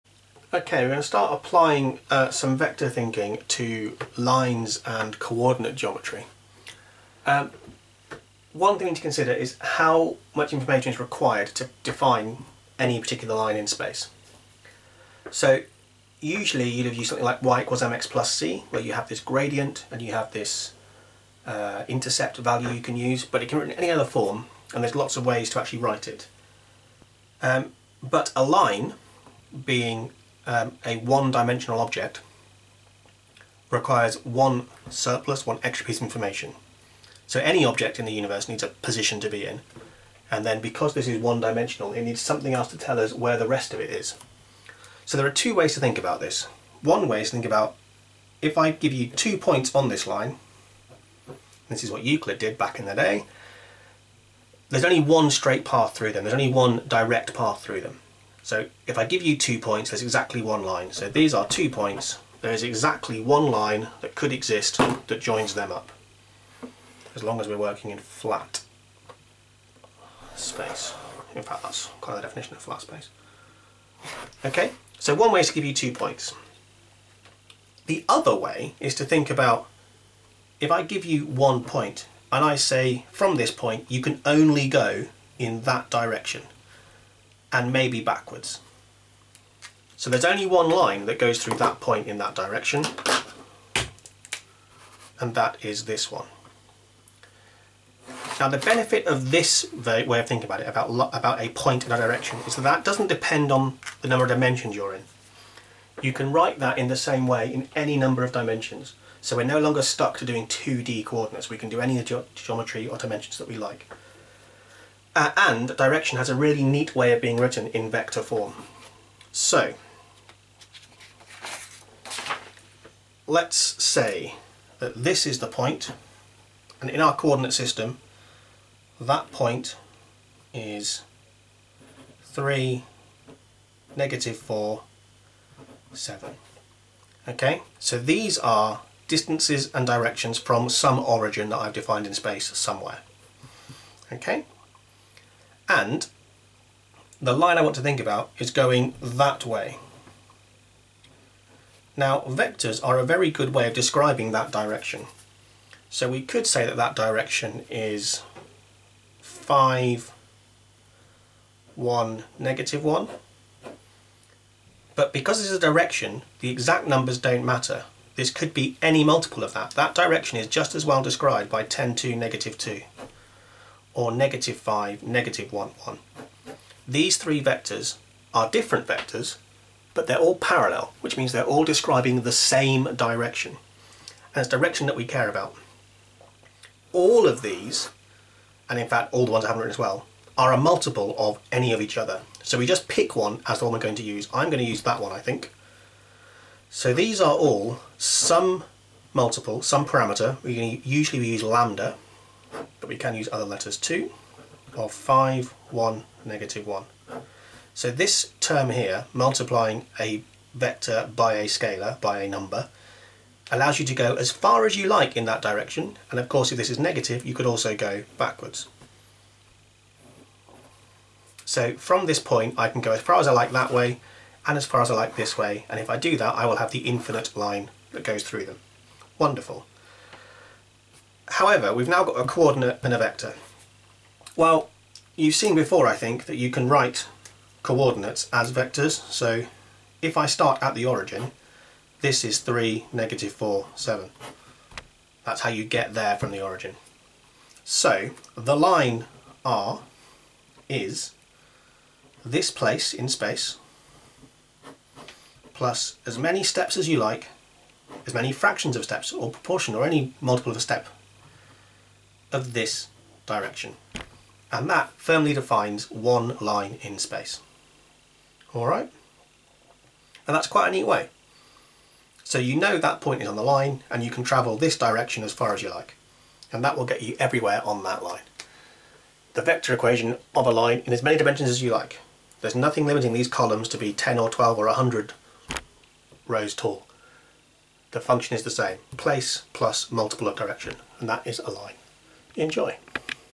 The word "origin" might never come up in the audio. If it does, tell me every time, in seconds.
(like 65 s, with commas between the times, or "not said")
140 s, 240 s, 246 s.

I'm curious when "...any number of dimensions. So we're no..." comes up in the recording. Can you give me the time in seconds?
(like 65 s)
107 s.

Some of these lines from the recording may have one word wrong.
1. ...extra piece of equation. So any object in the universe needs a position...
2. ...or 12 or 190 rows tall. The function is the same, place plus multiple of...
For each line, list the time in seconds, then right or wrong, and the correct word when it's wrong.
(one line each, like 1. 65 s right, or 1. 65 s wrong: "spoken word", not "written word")
1. 35 s wrong: "information", not "equation"
2. 284 s wrong: "100", not "190".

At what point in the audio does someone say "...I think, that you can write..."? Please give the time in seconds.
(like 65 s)
235 s.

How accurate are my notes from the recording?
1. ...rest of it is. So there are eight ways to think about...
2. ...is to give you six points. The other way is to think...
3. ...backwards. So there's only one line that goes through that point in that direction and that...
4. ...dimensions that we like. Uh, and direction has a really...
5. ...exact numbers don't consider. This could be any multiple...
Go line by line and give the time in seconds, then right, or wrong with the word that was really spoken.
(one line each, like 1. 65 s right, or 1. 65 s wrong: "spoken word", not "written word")
1. 43 s wrong: "two", not "eight"
2. 75 s wrong: "two", not "six"
3. 88 s right
4. 112 s right
5. 166 s wrong: "matter", not "consider".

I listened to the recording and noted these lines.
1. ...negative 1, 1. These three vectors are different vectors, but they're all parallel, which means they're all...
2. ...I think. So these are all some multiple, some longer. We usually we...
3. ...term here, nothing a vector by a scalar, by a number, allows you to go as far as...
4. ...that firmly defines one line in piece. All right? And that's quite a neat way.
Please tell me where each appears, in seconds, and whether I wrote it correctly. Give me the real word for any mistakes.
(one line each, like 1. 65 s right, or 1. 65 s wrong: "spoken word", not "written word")
1. 175 s right
2. 195 s wrong: "parameter", not "longer"
3. 208 s wrong: "multiplying", not "nothing"
4. 264 s wrong: "space", not "piece".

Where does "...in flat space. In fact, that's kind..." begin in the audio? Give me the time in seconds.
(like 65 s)
67 s.